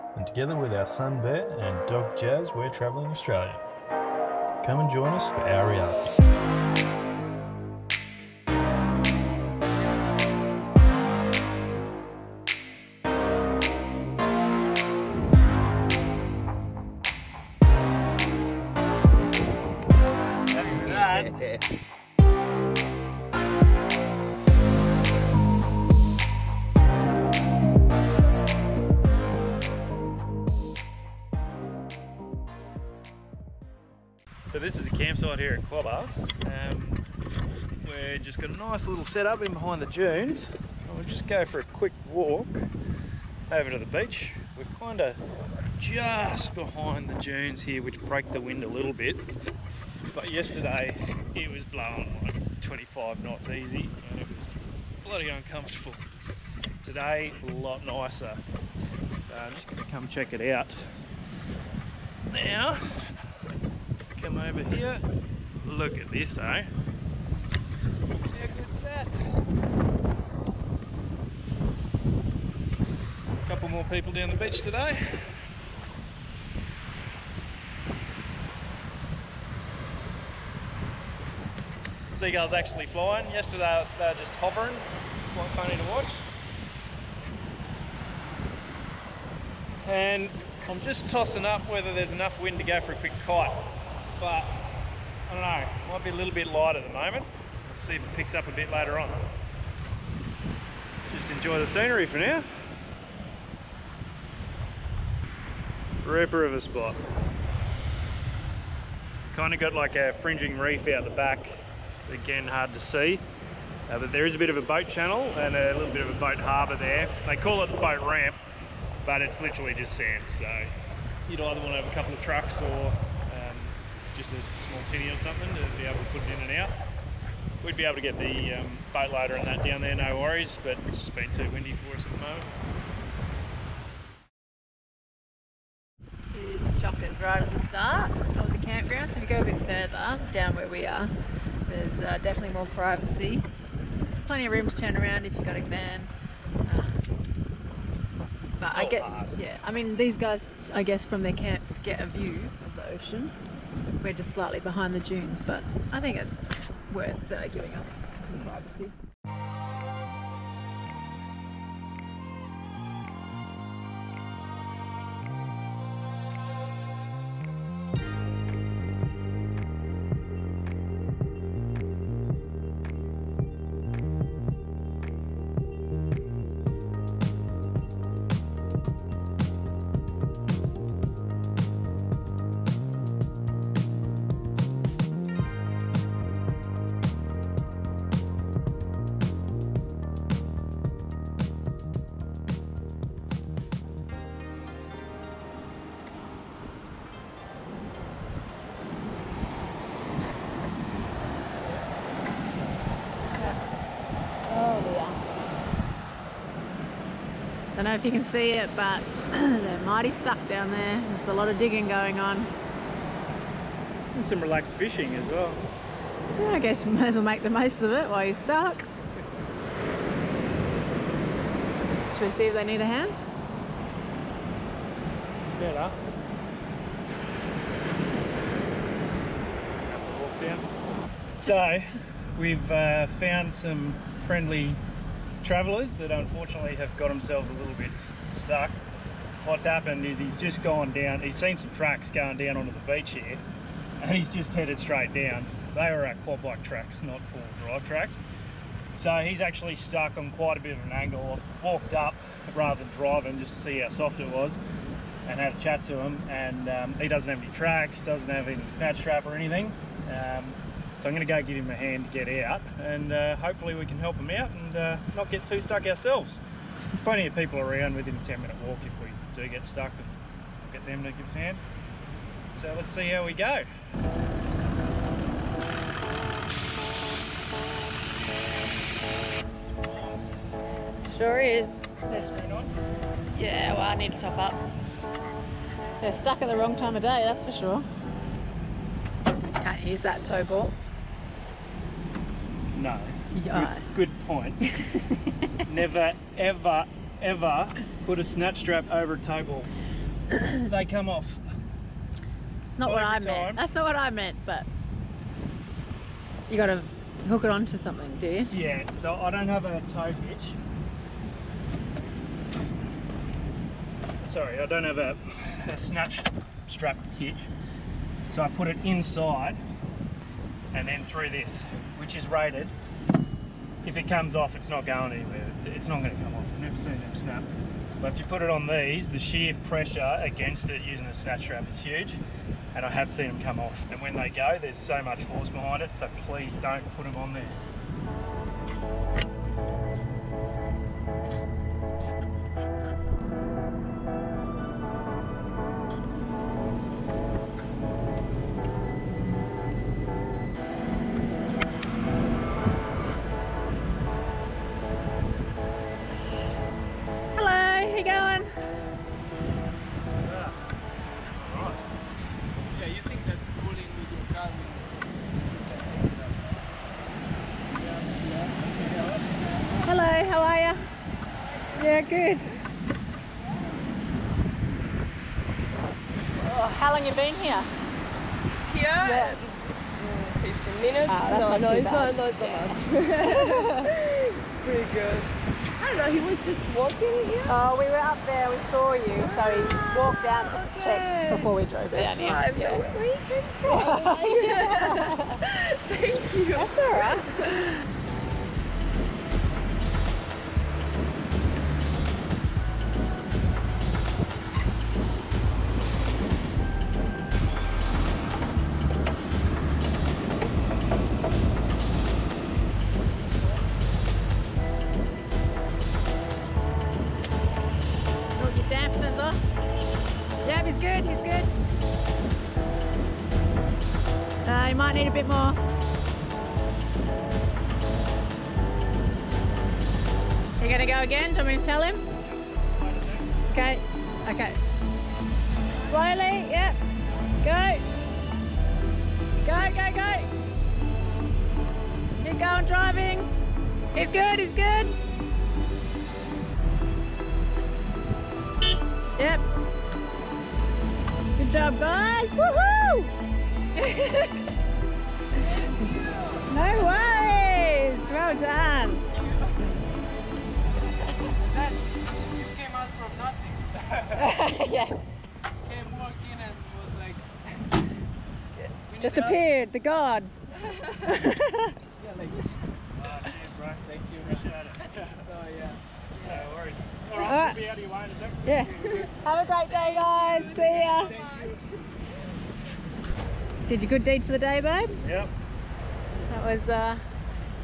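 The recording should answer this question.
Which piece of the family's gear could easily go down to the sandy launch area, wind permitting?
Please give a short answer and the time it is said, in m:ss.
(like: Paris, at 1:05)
boat loader, at 2:08.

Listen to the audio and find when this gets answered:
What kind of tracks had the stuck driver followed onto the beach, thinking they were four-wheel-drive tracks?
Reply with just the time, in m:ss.
4:06.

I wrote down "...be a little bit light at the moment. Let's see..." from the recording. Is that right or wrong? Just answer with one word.
right.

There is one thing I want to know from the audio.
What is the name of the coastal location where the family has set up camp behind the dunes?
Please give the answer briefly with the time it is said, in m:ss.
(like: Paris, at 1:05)
Quobba, at 0:35.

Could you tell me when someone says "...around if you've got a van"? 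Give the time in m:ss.
2:24.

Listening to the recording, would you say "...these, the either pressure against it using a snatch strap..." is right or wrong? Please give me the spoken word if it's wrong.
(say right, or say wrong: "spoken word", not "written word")
wrong: "sheer", not "either".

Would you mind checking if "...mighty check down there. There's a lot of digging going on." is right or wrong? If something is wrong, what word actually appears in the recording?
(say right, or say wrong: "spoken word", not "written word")
wrong: "stuck", not "check".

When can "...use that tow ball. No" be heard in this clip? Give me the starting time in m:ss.
4:49.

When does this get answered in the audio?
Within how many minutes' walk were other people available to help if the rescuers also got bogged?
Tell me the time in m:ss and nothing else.
4:28.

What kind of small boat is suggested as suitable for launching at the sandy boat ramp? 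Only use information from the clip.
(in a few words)
tinny.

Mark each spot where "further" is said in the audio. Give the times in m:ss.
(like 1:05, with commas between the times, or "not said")
2:19.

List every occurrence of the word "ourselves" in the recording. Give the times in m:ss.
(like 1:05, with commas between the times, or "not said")
4:25.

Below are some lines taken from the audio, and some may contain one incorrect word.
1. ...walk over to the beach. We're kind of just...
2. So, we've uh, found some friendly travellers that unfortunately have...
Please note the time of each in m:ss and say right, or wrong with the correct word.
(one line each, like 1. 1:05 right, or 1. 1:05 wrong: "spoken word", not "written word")
1. 0:42 right
2. 3:51 right.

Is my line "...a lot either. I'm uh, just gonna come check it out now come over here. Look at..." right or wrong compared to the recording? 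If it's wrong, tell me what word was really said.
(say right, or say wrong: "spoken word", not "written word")
wrong: "nicer", not "either".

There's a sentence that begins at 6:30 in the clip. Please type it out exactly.
check before we drove That's down here.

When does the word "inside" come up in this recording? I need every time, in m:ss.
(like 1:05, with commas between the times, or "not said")
5:18.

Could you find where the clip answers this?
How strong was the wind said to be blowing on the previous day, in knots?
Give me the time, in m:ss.
0:52.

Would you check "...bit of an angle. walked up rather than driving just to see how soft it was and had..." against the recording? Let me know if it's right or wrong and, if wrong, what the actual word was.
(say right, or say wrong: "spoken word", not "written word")
right.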